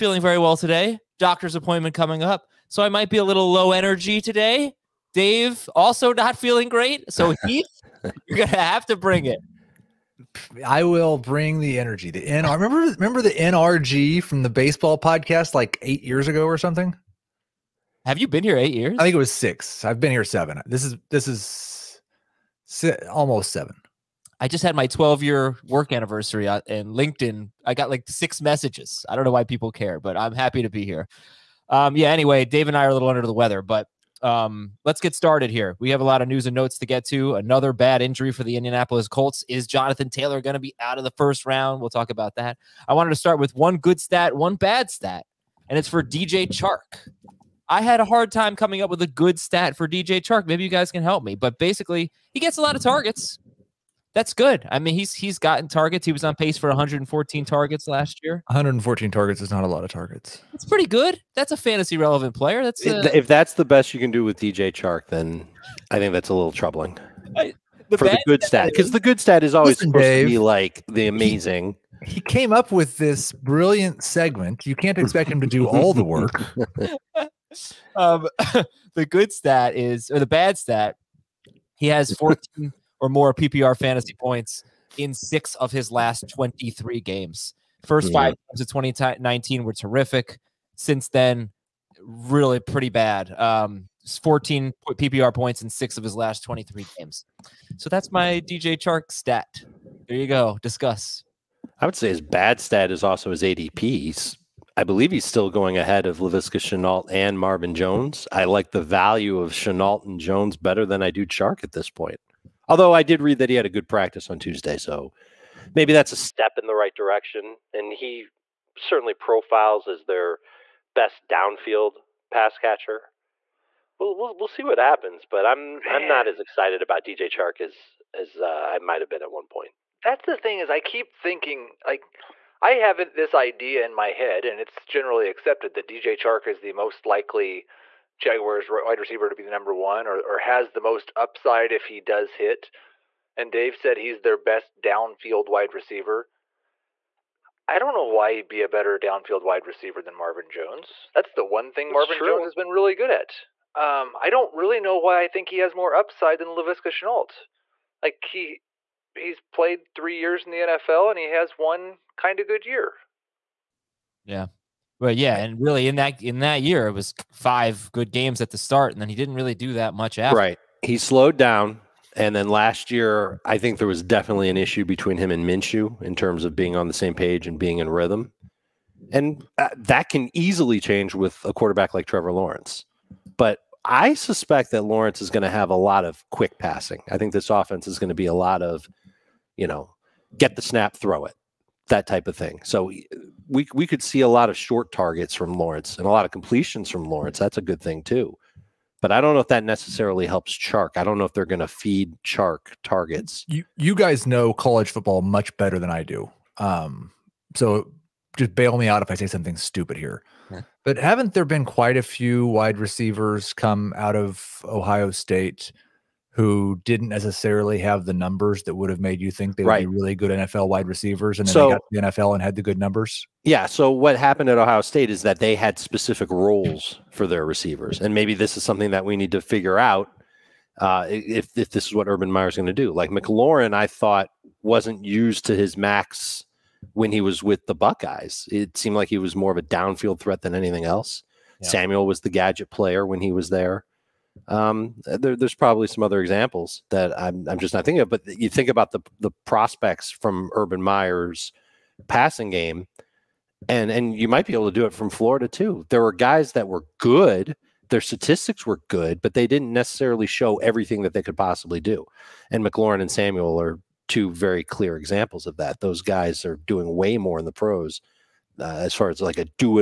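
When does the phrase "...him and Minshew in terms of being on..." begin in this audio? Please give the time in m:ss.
2:55.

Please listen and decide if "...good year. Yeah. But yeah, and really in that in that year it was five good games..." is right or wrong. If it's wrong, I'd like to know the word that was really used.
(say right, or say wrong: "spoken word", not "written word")
right.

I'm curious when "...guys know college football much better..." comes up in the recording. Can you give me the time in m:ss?
3:23.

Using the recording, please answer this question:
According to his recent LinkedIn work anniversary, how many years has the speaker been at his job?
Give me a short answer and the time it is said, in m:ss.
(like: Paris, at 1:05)
12, at 0:24.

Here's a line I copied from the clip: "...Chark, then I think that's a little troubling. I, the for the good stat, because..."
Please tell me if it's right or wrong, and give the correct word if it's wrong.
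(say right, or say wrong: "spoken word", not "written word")
right.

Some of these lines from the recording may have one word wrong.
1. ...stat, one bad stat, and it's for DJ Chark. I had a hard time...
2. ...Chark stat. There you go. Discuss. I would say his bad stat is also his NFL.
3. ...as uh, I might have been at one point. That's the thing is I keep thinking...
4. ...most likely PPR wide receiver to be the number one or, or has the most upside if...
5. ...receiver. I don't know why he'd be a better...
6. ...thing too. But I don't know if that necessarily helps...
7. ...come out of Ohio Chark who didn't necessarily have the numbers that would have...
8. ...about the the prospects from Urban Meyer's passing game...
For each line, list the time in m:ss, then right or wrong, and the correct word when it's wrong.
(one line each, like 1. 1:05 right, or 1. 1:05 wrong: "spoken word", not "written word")
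1. 0:44 right
2. 1:38 wrong: "ADP", not "NFL"
3. 2:08 right
4. 2:16 wrong: "Jaguars", not "PPR"
5. 2:25 right
6. 3:17 right
7. 3:33 wrong: "State", not "Chark"
8. 4:08 right.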